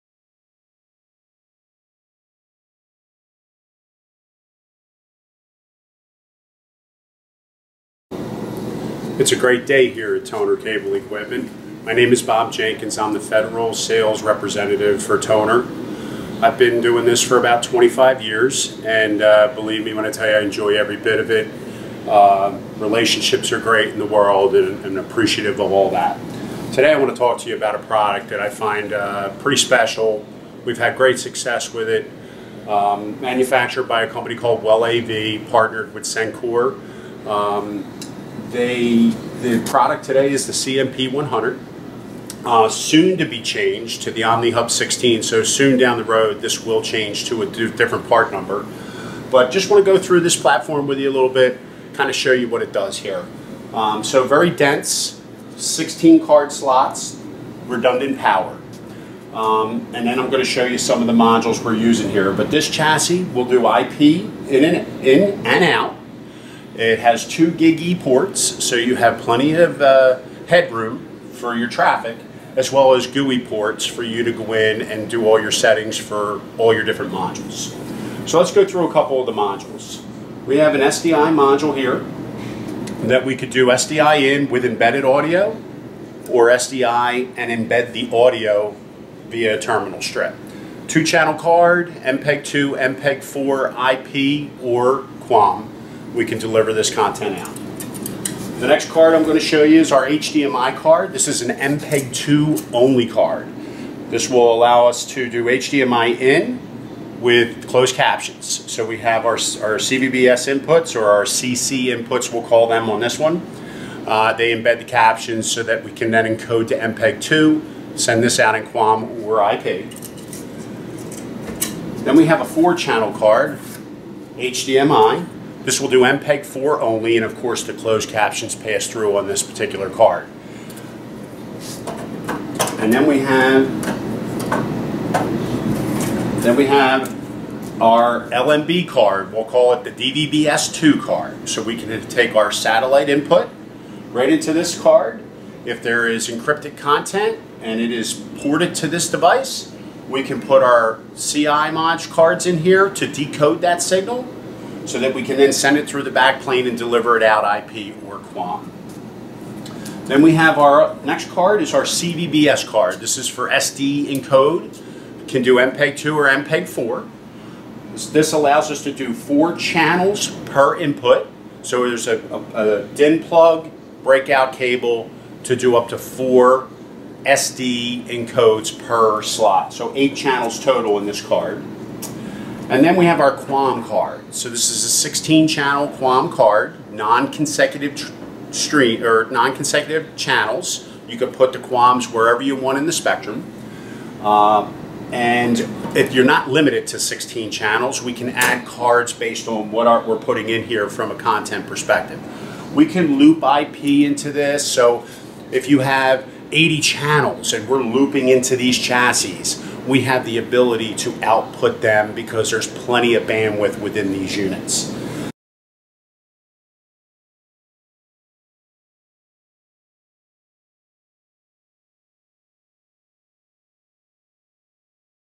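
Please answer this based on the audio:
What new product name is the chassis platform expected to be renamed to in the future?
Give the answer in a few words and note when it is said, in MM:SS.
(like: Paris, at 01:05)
OmniHub 16, at 00:44.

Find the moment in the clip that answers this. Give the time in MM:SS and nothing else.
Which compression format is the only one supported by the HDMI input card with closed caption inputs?
01:41.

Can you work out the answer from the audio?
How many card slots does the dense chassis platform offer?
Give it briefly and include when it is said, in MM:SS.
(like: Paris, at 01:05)
16, at 00:55.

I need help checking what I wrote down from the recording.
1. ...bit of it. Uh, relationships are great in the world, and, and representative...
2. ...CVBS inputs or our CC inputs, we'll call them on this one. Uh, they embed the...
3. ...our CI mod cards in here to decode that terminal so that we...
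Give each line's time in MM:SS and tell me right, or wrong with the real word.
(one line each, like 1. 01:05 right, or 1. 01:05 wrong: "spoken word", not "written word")
1. 00:20 wrong: "appreciative", not "representative"
2. 01:49 right
3. 02:30 wrong: "signal", not "terminal".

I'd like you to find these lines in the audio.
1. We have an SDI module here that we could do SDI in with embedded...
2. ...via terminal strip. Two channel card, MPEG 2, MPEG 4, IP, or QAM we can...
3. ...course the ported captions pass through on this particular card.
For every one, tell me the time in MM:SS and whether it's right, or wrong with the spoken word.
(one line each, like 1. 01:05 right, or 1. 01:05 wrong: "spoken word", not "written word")
1. 01:20 right
2. 01:29 right
3. 02:07 wrong: "closed", not "ported".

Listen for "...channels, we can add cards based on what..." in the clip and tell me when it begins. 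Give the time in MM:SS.
03:17.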